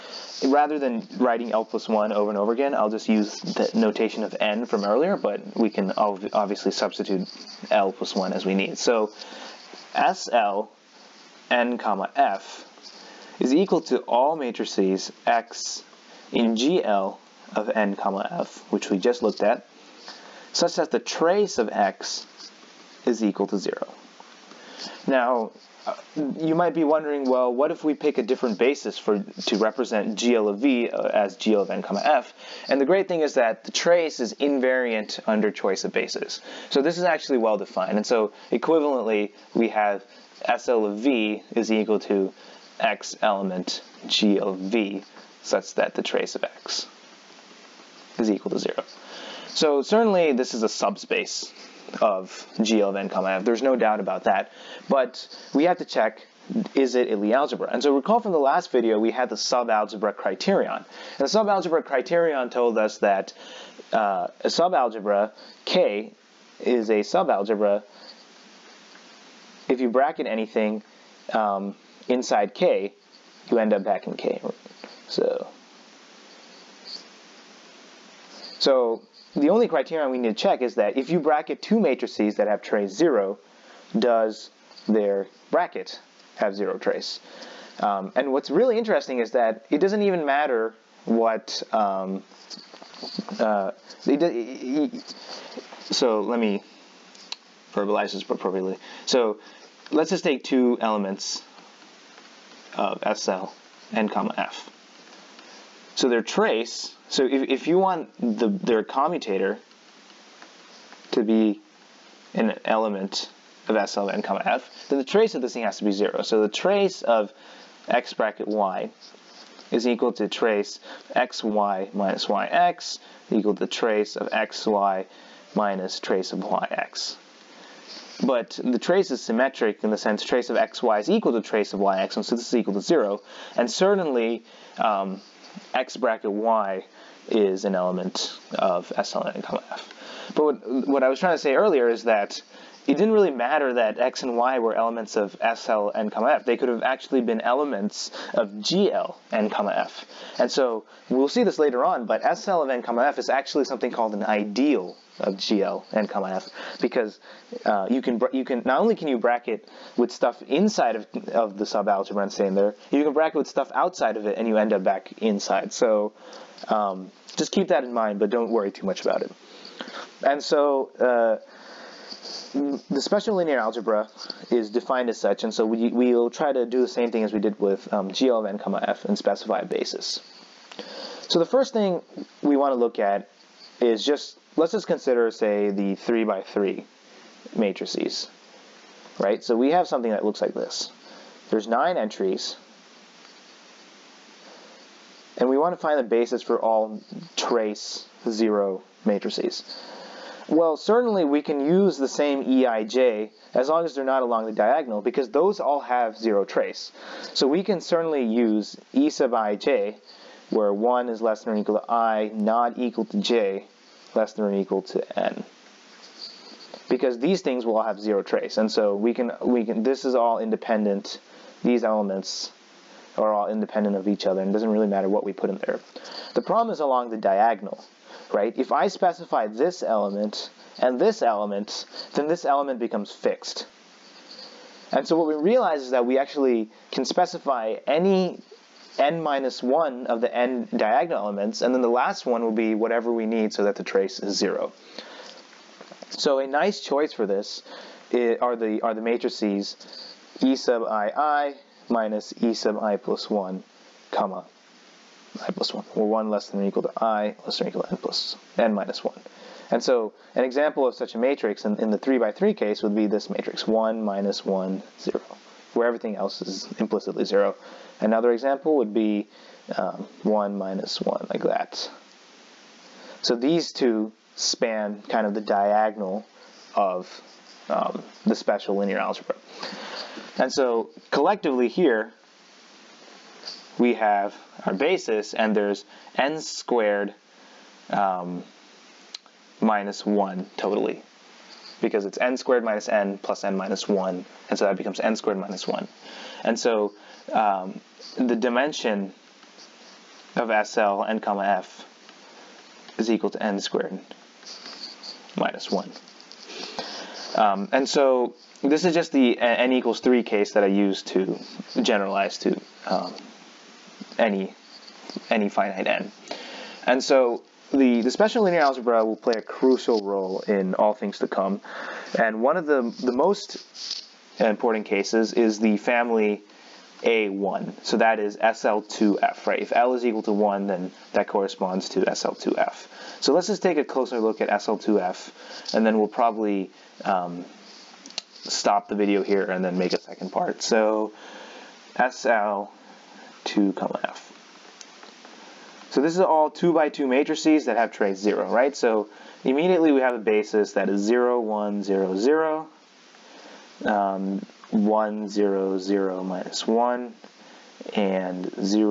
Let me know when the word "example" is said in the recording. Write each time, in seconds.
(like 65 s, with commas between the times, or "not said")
260 s, 268 s.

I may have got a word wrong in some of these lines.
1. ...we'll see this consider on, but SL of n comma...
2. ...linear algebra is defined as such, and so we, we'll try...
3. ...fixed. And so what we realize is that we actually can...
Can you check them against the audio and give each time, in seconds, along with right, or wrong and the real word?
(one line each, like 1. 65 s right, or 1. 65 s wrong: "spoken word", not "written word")
1. 151 s wrong: "later", not "consider"
2. 173 s right
3. 233 s right.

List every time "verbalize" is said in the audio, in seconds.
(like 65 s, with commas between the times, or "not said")
97 s.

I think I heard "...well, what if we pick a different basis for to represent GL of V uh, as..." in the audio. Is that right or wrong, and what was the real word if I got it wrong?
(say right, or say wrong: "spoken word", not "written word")
right.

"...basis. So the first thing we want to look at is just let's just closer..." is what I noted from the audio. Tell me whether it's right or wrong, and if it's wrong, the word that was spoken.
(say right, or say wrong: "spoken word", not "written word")
wrong: "consider", not "closer".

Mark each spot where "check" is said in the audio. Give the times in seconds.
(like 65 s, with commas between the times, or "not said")
55 s, 80 s.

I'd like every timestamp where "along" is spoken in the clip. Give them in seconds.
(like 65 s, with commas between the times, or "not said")
204 s, 226 s.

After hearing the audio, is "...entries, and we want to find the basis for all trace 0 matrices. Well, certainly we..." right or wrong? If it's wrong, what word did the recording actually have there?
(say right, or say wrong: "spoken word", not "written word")
right.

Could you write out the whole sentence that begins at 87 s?
Um, and what's really interesting is that it doesn't even matter what...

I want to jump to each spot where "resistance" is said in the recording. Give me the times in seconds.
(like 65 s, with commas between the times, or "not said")
not said.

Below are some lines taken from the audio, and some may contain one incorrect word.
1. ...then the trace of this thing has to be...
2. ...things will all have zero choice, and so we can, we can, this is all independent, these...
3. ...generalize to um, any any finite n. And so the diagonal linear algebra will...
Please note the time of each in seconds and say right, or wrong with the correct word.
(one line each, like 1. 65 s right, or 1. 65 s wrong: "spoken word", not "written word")
1. 114 s right
2. 217 s wrong: "trace", not "choice"
3. 311 s wrong: "special", not "diagonal".